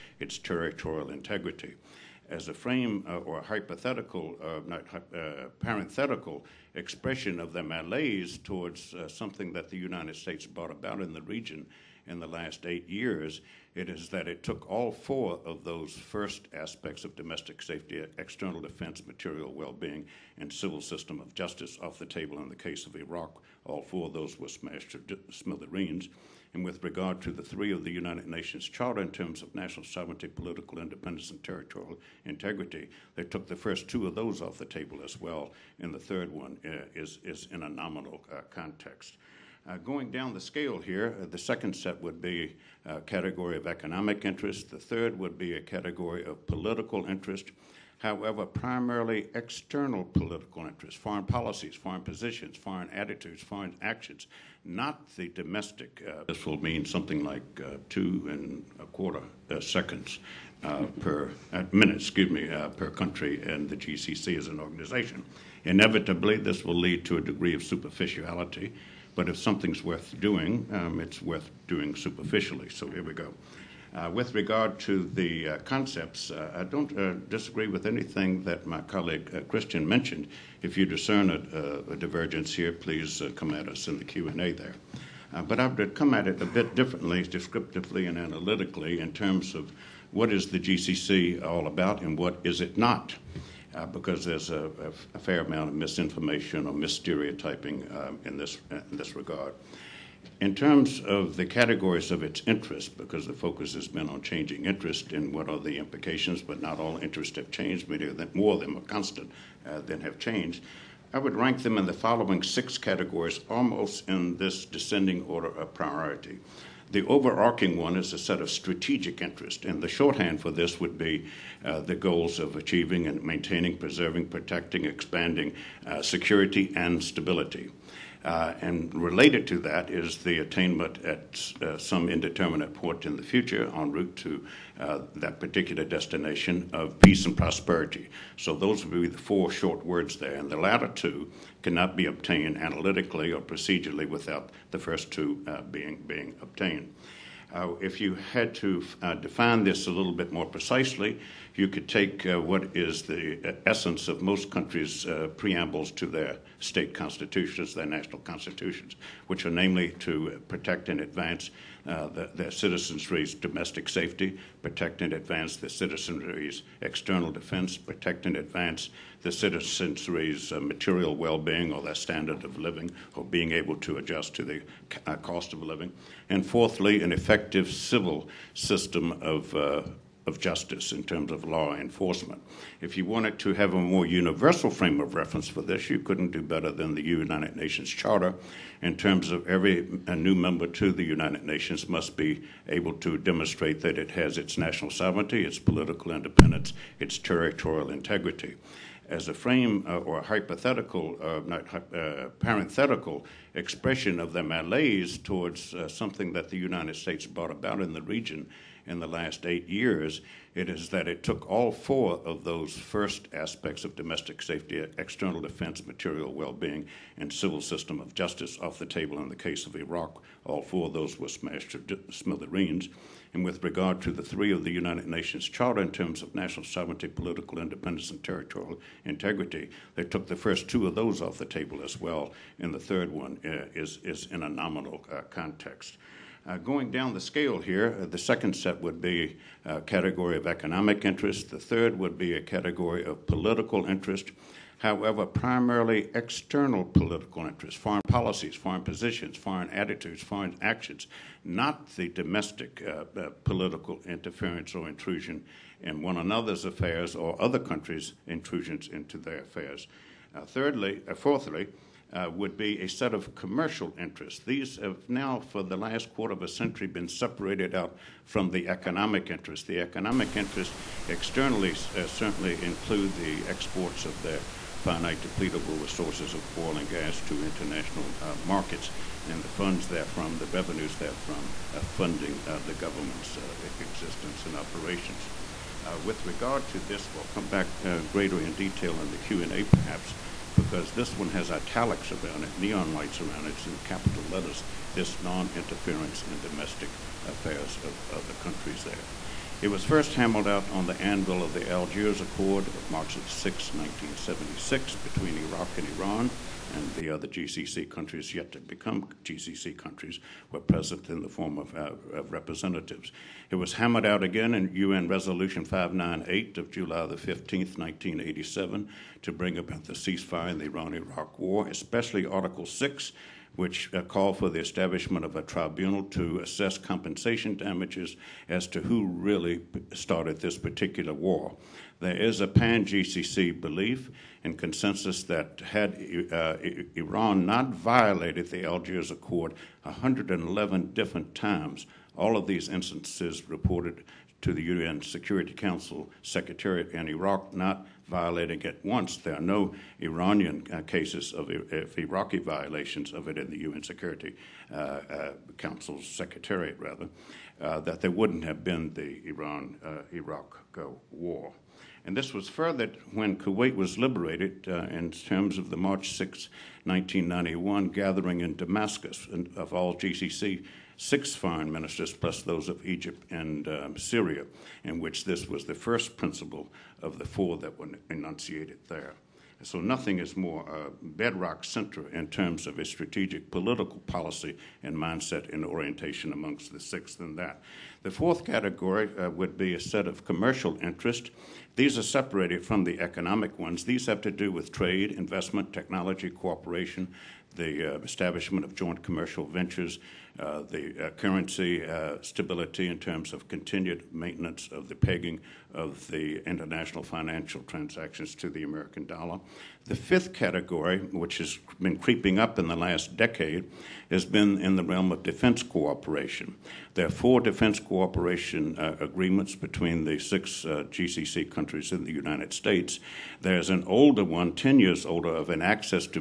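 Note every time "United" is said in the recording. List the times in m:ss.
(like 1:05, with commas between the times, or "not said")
0:09, 0:27, 3:07, 3:11, 3:26, 3:44, 7:02.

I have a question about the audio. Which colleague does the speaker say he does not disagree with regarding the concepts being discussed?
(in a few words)
Christian.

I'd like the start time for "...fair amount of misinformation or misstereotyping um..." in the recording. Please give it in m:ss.
1:35.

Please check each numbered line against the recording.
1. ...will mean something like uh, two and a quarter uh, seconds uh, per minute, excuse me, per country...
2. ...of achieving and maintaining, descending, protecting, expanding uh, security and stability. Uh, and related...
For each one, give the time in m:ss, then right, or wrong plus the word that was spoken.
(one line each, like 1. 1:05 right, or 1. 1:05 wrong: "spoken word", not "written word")
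1. 0:56 right
2. 2:02 wrong: "preserving", not "descending".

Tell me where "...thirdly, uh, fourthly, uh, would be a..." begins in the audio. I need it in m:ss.
4:20.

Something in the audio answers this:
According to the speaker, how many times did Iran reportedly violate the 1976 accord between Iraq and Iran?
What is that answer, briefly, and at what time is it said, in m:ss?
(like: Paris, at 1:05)
111, at 5:39.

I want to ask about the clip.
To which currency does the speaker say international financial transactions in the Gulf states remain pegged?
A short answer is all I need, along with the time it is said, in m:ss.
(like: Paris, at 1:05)
American dollar, at 6:48.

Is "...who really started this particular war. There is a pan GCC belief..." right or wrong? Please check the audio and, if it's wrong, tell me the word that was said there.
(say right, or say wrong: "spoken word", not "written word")
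right.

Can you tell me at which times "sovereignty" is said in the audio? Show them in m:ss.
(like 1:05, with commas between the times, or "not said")
0:29, 3:14, 3:46.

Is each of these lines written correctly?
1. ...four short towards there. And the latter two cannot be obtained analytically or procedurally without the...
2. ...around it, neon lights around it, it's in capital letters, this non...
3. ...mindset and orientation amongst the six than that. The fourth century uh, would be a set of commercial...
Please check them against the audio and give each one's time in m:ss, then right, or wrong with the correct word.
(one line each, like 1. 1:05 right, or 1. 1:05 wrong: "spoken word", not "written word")
1. 2:19 wrong: "words", not "towards"
2. 4:52 right
3. 6:24 wrong: "category", not "century".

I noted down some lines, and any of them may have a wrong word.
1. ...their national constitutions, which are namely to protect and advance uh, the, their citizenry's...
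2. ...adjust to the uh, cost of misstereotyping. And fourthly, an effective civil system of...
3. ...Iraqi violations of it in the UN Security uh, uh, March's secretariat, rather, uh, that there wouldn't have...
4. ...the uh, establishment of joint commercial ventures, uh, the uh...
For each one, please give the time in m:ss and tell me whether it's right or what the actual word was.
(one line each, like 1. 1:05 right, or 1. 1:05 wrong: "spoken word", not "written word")
1. 2:37 right
2. 2:53 wrong: "living", not "misstereotyping"
3. 5:51 wrong: "Council", not "March"
4. 6:37 right.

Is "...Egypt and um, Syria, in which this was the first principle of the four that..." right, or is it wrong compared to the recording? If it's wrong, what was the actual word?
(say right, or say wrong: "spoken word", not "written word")
right.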